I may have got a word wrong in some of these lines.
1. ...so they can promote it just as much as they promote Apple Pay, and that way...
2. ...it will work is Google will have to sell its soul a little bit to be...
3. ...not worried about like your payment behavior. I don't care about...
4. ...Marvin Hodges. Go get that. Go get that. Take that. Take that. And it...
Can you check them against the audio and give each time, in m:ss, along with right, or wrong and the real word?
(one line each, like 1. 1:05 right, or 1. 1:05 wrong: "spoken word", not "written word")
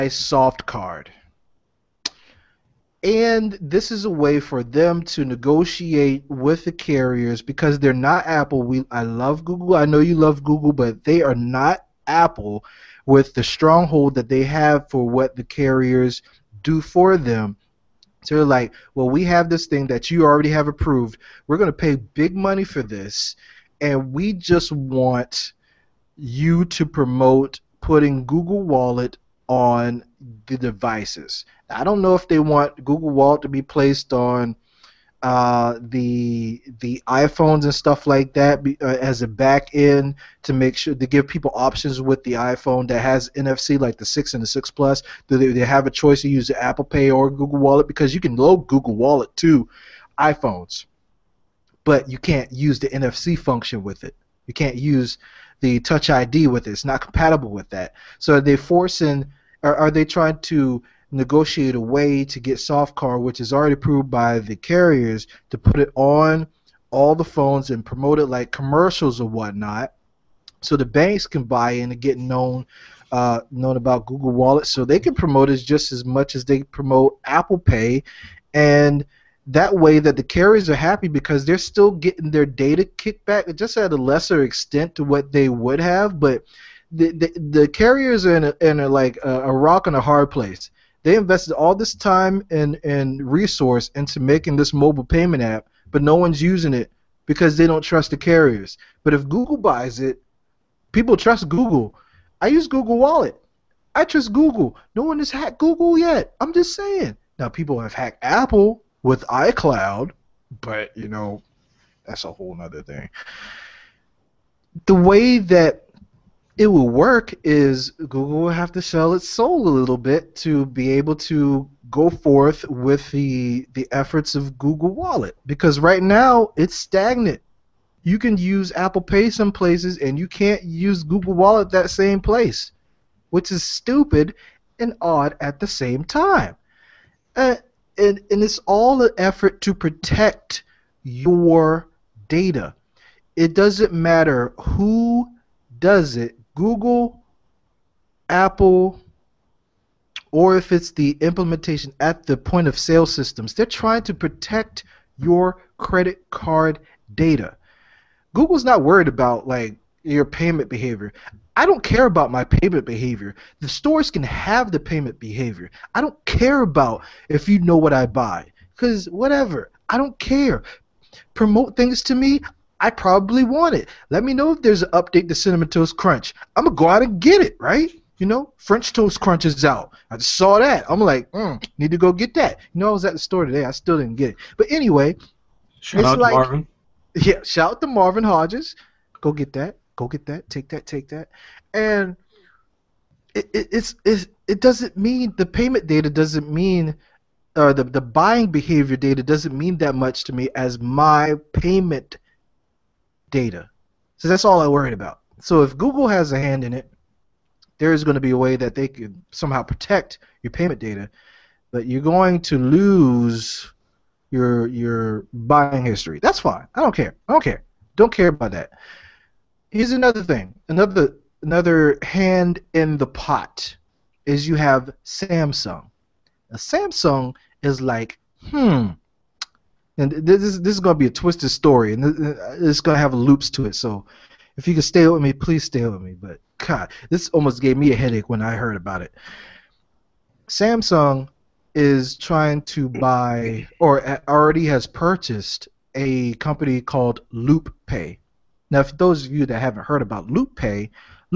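1. 1:14 right
2. 1:56 right
3. 2:38 right
4. 3:07 right.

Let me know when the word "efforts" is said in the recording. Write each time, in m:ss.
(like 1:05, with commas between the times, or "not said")
2:03, 2:19.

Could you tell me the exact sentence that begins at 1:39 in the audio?
But if Google buys it, people trust Google.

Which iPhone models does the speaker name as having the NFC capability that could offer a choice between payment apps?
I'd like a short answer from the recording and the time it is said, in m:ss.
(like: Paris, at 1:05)
6 and 6 Plus, at 0:43.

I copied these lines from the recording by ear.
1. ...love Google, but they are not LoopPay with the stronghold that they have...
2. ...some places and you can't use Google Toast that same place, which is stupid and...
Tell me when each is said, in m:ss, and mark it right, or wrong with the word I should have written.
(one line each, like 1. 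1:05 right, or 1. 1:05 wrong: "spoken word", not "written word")
1. 0:10 wrong: "Apple", not "LoopPay"
2. 2:09 wrong: "Wallet", not "Toast".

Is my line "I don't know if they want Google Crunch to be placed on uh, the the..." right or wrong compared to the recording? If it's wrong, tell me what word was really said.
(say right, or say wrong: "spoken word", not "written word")
wrong: "Wallet", not "Crunch".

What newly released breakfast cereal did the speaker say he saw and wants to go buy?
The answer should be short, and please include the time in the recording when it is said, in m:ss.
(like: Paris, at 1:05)
French Toast Crunch, at 2:58.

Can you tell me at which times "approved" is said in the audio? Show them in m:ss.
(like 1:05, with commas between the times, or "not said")
0:20, 1:03.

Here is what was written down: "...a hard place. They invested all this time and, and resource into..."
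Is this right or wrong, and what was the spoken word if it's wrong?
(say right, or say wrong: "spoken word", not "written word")
right.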